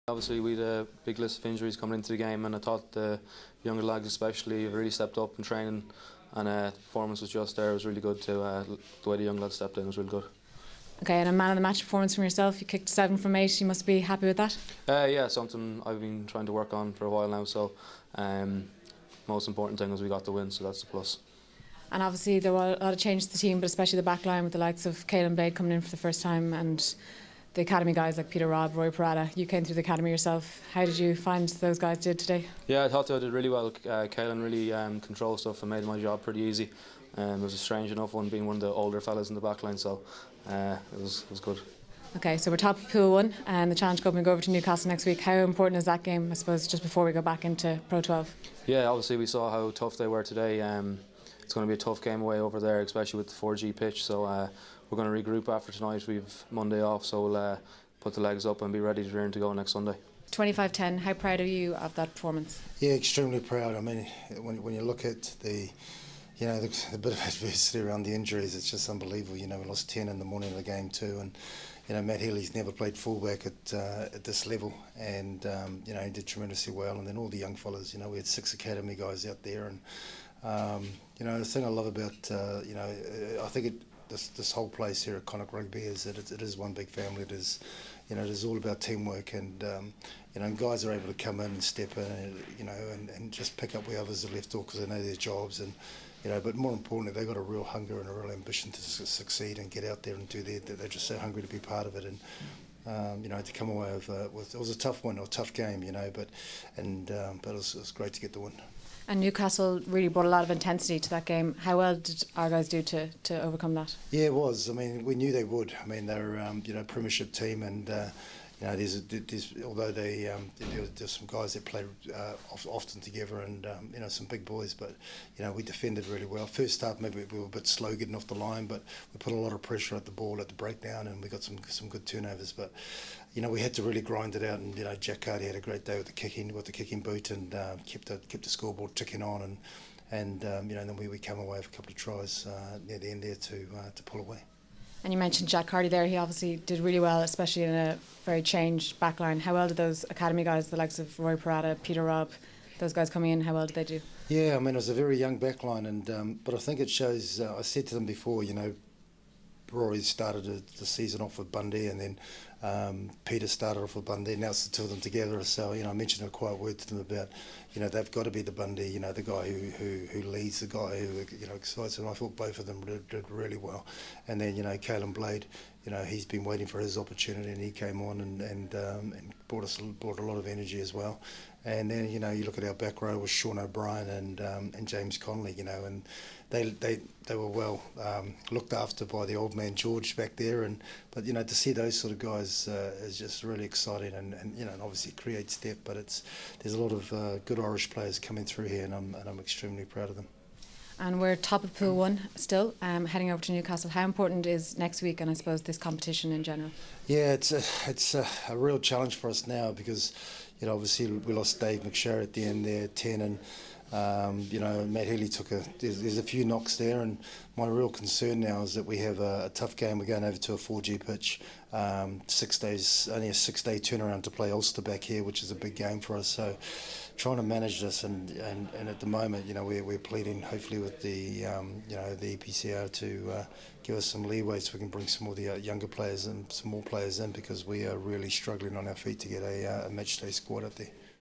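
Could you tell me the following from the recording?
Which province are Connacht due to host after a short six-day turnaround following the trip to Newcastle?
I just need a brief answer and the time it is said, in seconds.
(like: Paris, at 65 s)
Ulster, at 224 s.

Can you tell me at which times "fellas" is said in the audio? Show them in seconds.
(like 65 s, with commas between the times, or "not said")
39 s, 77 s.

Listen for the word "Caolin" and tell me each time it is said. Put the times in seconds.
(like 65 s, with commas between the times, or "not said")
25 s, 174 s.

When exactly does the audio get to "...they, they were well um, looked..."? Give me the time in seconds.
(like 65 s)
186 s.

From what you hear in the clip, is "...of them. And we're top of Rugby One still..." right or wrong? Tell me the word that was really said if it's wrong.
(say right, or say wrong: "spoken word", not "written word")
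wrong: "Pool", not "Rugby".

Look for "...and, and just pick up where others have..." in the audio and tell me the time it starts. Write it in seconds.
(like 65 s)
92 s.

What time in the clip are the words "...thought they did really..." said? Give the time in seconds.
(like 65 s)
32 s.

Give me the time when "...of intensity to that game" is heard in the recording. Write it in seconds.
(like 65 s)
110 s.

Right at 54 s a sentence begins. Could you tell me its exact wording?
So uh, we're going to regroup after tonight.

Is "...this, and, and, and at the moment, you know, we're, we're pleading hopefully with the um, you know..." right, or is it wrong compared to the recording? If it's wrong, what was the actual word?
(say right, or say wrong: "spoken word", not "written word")
right.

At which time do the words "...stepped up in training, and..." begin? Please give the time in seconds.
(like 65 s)
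4 s.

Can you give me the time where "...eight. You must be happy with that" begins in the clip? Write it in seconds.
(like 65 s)
13 s.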